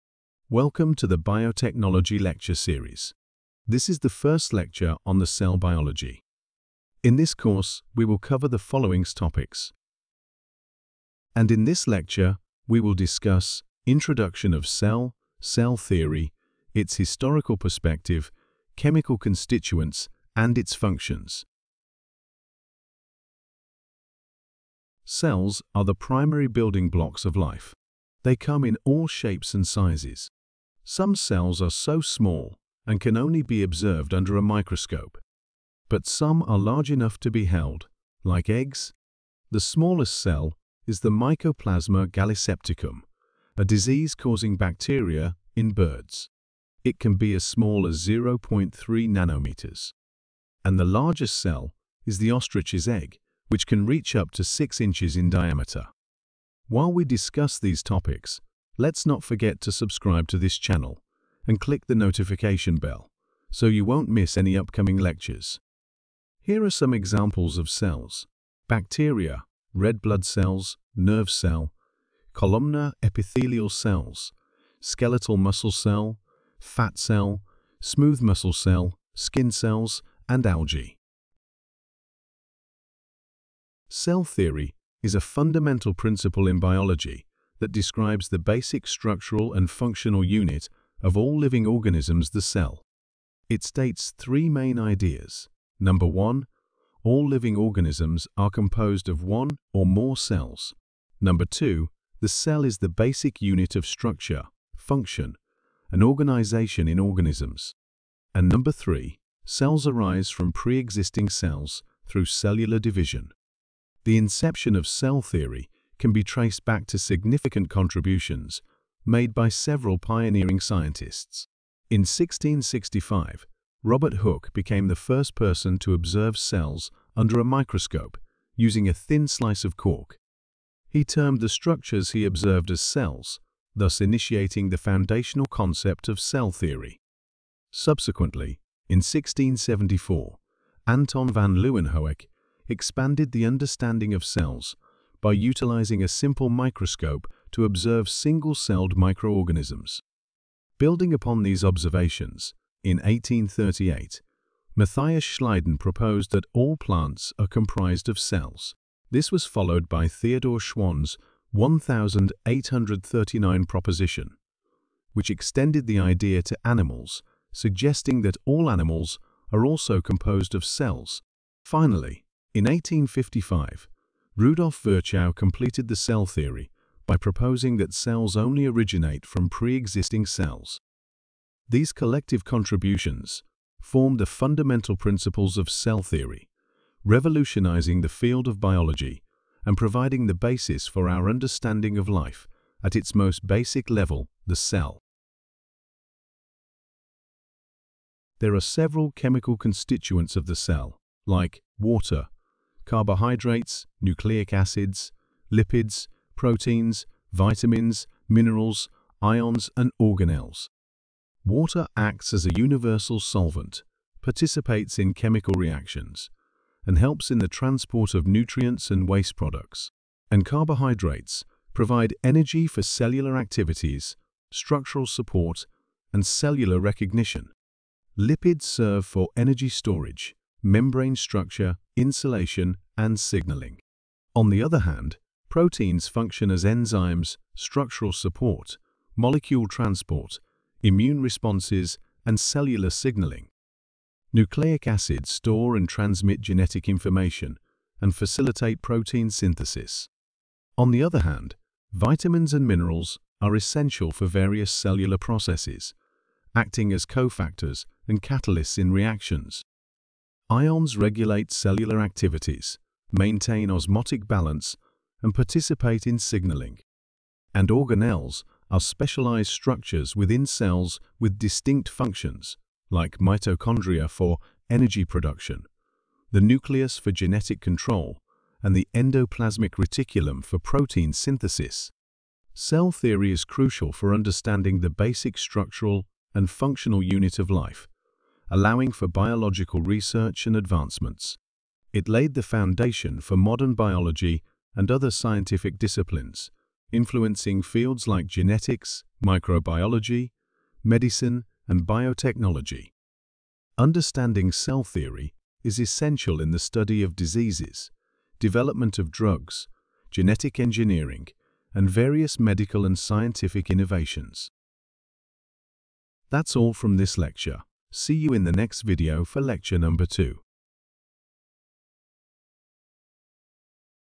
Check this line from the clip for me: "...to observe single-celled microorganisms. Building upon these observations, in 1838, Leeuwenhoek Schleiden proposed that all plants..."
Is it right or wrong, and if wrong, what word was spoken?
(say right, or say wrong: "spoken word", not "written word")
wrong: "Matthias", not "Leeuwenhoek".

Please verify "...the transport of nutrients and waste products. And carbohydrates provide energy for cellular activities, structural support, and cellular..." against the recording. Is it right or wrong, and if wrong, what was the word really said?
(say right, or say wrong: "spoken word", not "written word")
right.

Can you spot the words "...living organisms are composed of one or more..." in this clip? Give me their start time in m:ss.
1:37.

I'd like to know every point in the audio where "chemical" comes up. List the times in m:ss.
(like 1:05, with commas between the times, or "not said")
0:18, 3:19, 3:35.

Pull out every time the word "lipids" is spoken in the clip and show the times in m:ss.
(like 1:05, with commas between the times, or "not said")
3:25, 3:48.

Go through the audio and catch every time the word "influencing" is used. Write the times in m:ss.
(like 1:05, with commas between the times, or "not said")
4:56.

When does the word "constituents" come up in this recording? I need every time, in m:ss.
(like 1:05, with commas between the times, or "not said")
0:19, 3:19.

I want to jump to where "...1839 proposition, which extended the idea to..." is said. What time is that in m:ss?
2:41.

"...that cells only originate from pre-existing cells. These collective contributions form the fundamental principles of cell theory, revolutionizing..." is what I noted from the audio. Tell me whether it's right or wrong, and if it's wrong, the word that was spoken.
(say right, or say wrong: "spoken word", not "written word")
right.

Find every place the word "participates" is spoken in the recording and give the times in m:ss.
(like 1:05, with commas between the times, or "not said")
3:34, 4:25.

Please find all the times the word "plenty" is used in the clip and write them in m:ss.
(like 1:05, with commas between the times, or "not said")
not said.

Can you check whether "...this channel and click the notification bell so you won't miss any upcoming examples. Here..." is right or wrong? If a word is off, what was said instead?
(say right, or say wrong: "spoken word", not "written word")
wrong: "lectures", not "examples".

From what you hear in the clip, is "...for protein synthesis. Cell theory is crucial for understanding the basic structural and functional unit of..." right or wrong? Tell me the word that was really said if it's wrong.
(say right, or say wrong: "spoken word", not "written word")
right.